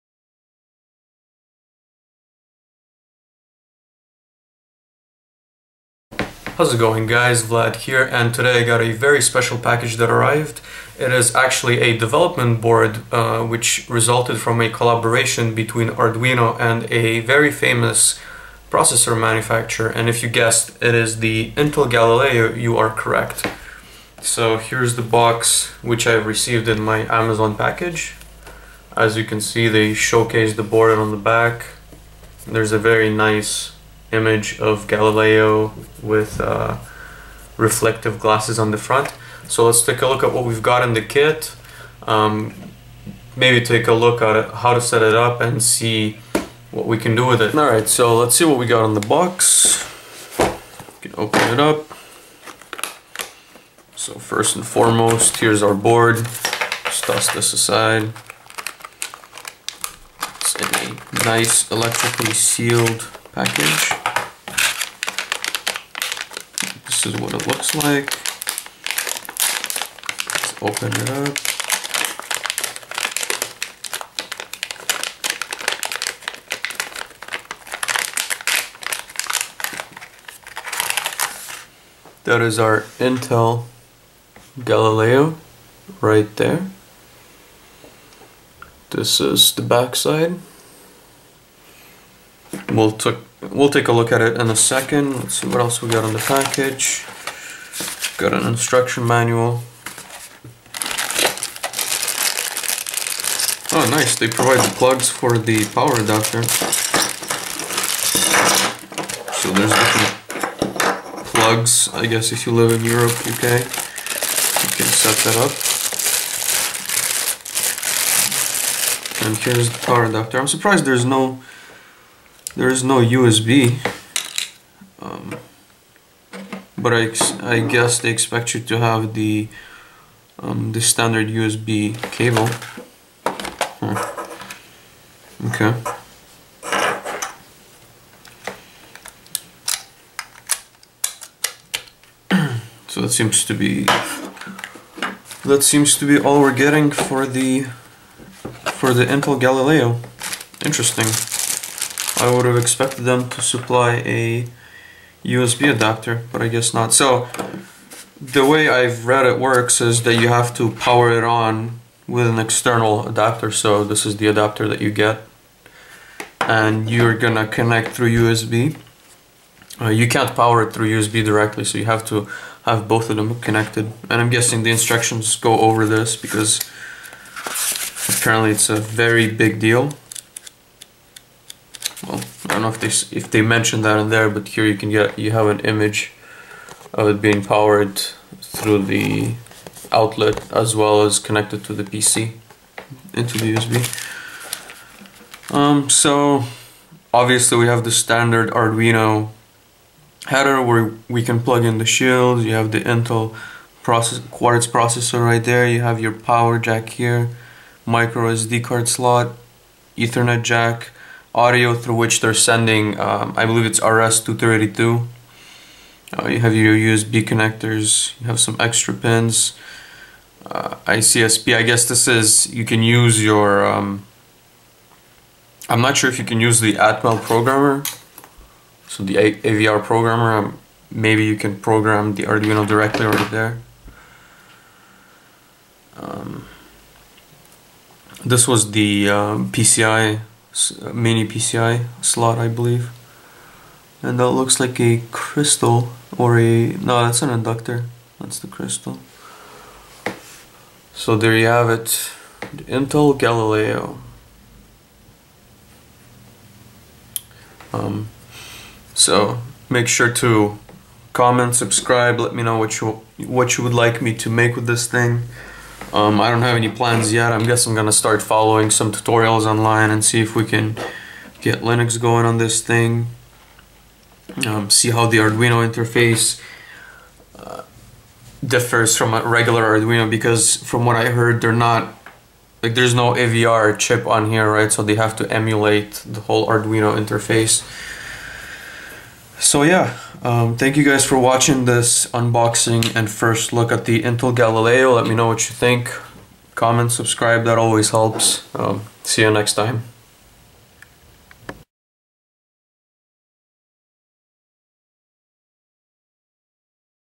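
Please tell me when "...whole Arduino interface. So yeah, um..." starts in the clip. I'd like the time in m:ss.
4:46.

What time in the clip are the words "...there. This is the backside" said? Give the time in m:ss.
1:26.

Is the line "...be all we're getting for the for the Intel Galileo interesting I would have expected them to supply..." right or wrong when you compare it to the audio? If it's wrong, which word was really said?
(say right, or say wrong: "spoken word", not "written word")
right.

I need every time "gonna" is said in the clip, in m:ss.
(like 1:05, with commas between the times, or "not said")
2:47, 4:27.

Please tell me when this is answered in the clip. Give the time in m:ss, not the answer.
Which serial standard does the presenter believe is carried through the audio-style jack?
3:33.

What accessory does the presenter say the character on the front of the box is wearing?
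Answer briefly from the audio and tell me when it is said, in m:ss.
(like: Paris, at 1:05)
reflective glasses, at 0:37.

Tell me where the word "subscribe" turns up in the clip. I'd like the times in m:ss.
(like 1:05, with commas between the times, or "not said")
4:21, 4:56.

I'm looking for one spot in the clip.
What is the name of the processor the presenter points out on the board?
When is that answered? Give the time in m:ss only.
3:24.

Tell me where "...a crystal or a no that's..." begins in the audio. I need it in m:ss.
4:04.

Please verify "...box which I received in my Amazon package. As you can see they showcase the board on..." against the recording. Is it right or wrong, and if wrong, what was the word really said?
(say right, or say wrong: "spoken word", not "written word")
right.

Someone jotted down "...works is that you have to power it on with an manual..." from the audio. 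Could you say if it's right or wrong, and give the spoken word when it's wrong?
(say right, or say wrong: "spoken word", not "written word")
wrong: "external", not "manual".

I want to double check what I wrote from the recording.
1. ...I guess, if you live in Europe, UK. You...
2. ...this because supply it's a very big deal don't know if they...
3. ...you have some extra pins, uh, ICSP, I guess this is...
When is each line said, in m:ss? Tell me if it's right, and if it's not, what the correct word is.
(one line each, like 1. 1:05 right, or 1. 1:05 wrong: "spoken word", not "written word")
1. 1:51 right
2. 2:55 wrong: "apparently", not "supply"
3. 3:38 right.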